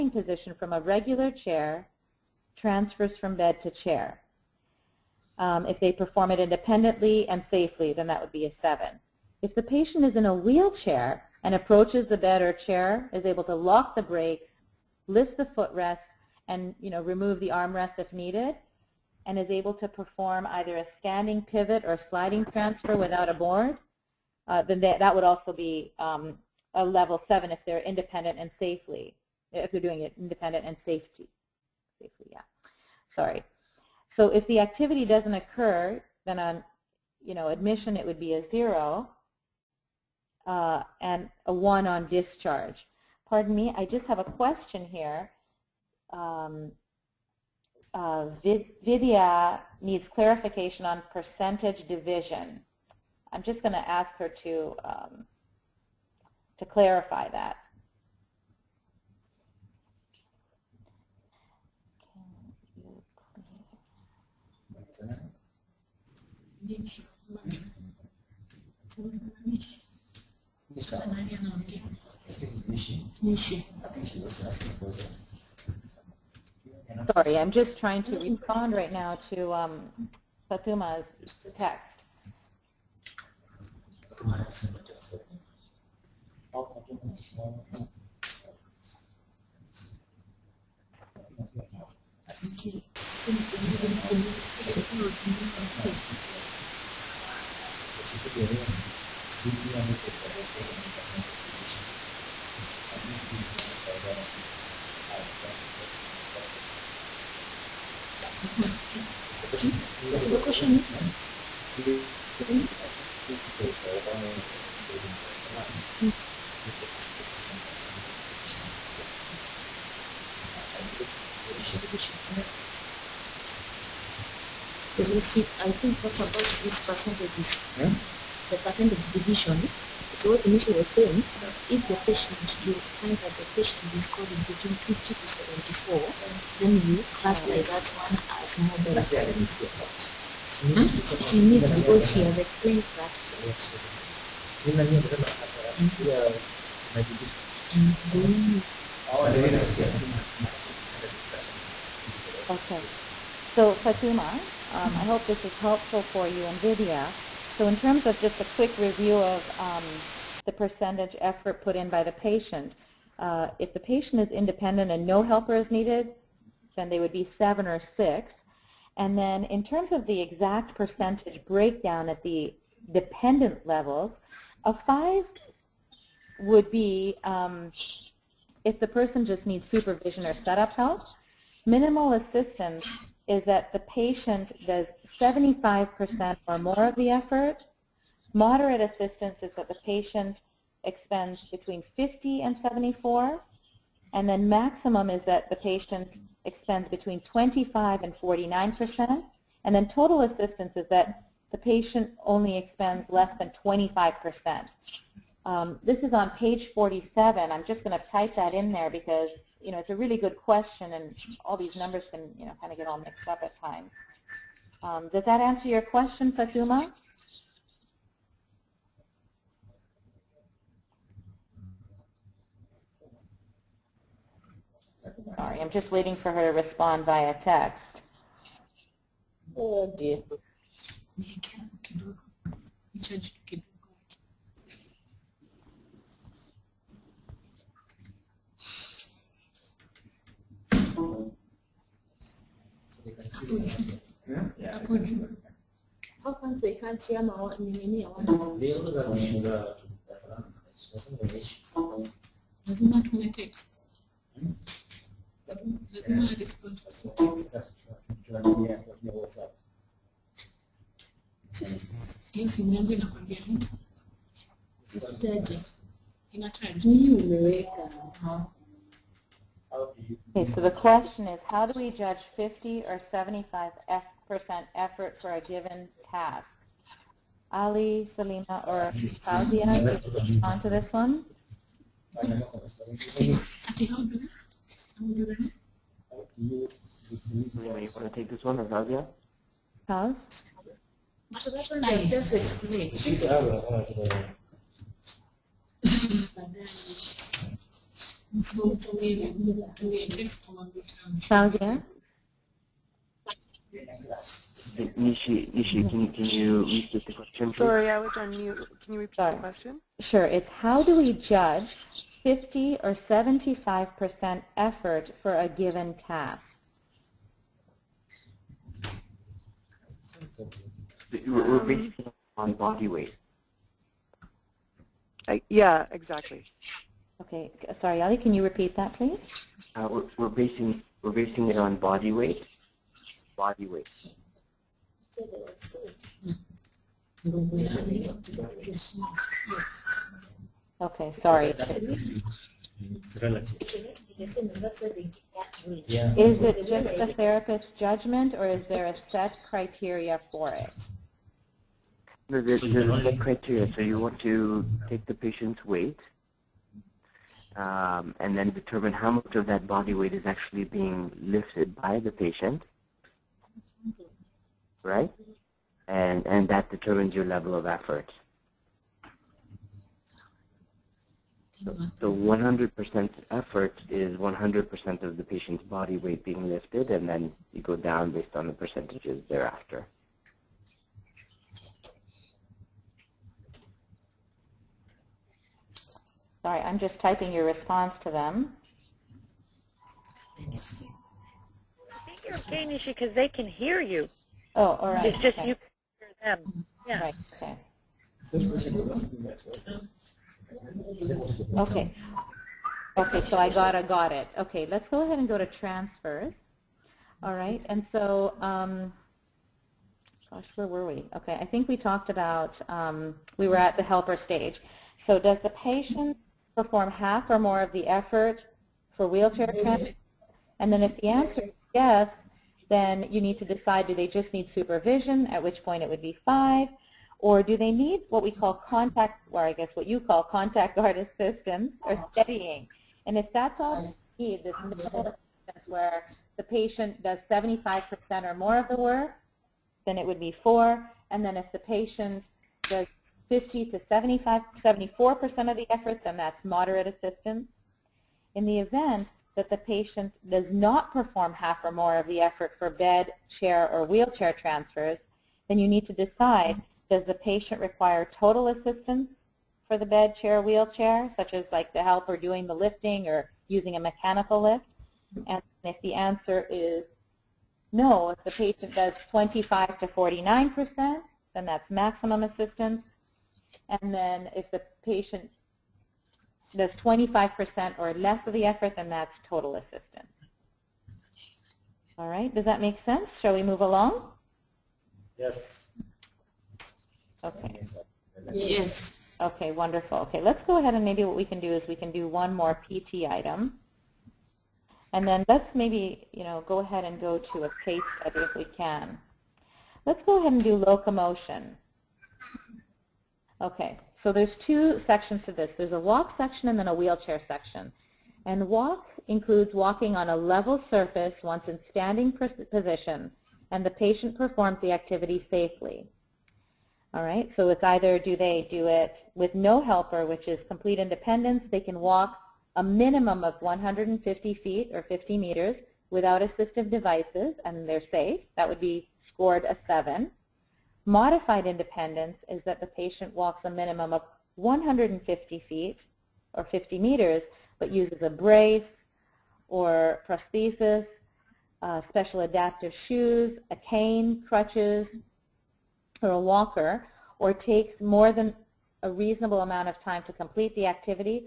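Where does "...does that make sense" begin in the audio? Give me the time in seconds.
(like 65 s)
482 s.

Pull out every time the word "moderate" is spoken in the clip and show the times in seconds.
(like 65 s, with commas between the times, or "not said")
138 s, 188 s, 446 s.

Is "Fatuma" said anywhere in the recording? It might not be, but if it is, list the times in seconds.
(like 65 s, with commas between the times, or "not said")
153 s, 216 s.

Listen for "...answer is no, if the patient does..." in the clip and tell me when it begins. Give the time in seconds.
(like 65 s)
465 s.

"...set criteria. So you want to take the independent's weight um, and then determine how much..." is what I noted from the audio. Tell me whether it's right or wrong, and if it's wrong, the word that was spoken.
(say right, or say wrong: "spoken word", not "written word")
wrong: "patient", not "independent".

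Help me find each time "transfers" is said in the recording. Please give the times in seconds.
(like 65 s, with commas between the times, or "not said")
2 s, 22 s, 405 s, 419 s, 454 s.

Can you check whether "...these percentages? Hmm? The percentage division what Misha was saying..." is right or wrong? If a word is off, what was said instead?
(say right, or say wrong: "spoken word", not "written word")
right.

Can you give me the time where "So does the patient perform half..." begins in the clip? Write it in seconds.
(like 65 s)
415 s.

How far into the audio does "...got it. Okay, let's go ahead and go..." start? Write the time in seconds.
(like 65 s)
403 s.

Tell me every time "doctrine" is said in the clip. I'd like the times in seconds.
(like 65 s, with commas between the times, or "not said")
not said.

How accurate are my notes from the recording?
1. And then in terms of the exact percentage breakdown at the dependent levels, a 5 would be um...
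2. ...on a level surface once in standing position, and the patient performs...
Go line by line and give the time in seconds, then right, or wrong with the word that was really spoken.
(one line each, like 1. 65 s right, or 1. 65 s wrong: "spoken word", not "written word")
1. 168 s right
2. 509 s right.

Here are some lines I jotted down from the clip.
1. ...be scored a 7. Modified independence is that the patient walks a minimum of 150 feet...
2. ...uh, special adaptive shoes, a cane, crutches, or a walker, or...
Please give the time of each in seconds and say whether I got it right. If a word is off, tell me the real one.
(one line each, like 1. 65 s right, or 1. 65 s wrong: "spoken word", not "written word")
1. 528 s right
2. 541 s right.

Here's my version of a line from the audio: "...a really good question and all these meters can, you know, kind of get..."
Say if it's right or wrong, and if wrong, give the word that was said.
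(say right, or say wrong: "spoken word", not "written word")
wrong: "numbers", not "meters".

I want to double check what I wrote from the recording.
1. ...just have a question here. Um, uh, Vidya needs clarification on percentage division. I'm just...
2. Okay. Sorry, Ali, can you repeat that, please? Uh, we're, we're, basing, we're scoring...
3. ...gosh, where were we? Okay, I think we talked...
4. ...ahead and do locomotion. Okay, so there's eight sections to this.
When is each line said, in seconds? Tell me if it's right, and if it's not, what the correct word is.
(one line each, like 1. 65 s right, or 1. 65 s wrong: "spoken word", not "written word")
1. 43 s right
2. 327 s wrong: "basing", not "scoring"
3. 410 s right
4. 500 s wrong: "two", not "eight".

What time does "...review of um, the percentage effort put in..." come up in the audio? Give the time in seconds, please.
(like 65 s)
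158 s.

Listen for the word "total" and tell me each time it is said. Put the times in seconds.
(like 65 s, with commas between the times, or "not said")
199 s, 458 s, 479 s.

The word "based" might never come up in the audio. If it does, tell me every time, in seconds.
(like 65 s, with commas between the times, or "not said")
378 s.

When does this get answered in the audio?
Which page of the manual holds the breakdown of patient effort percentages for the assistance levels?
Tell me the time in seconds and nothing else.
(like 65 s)
206 s.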